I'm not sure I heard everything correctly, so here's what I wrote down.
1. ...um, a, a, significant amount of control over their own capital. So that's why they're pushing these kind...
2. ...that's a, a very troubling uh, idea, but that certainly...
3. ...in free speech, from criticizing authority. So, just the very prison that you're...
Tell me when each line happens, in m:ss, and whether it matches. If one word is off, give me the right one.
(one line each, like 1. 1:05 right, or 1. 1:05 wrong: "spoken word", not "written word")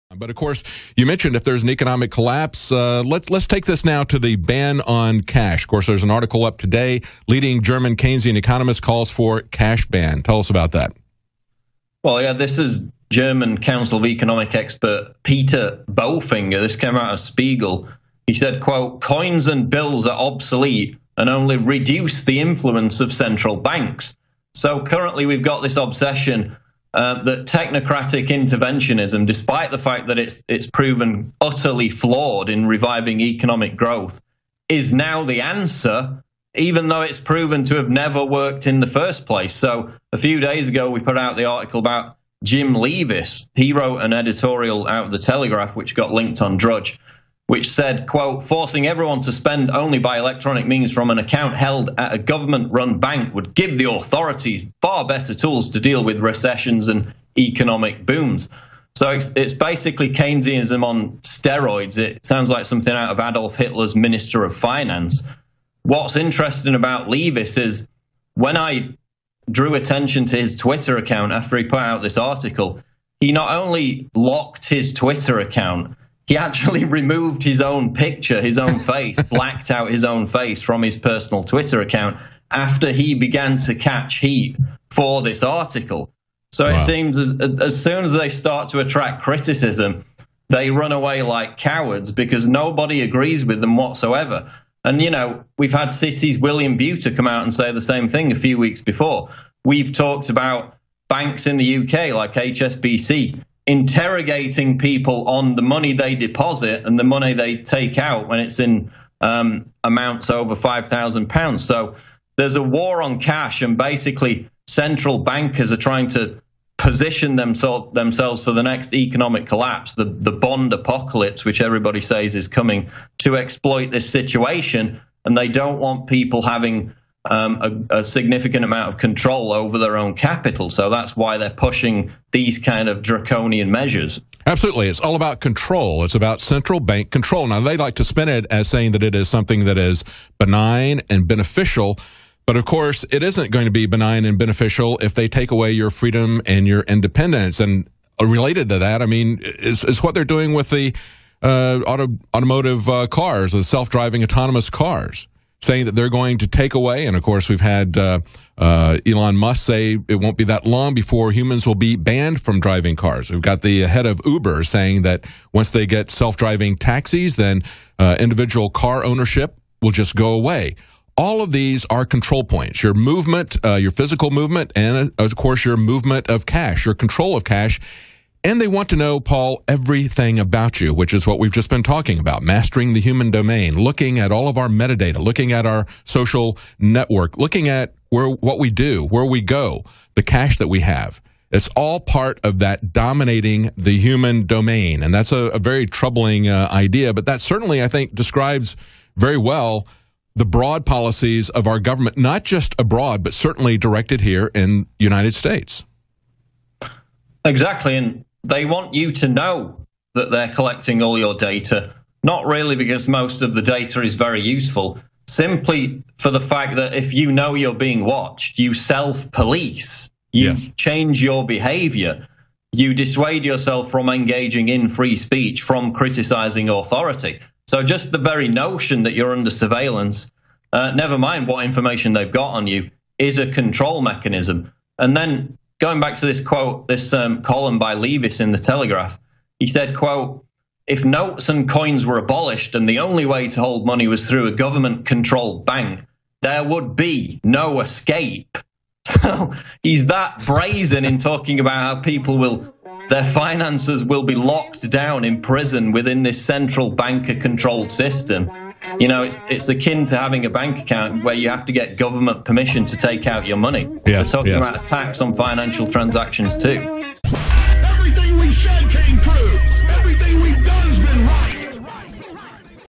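1. 2:07 right
2. 3:15 right
3. 3:44 wrong: "notion", not "prison".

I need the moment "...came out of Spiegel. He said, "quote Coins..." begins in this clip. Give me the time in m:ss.
0:16.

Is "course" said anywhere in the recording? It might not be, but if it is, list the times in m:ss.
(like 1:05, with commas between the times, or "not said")
0:00, 0:05, 2:22, 2:37, 2:55.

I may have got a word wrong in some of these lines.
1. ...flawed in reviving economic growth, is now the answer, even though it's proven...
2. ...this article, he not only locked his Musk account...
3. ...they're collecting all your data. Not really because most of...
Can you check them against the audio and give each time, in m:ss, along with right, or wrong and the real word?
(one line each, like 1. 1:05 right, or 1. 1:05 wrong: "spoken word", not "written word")
1. 0:31 right
2. 1:12 wrong: "Twitter", not "Musk"
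3. 3:30 right.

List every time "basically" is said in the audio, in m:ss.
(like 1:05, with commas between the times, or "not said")
0:59, 1:53.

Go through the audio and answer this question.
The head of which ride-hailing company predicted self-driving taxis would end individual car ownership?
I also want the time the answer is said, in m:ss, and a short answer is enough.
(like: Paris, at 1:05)
Uber, at 2:44.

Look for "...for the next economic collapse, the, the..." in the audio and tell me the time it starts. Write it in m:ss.
1:58.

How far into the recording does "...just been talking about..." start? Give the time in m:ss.
3:01.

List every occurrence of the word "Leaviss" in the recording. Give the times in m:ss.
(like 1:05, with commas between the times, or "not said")
0:42, 1:07, 3:57.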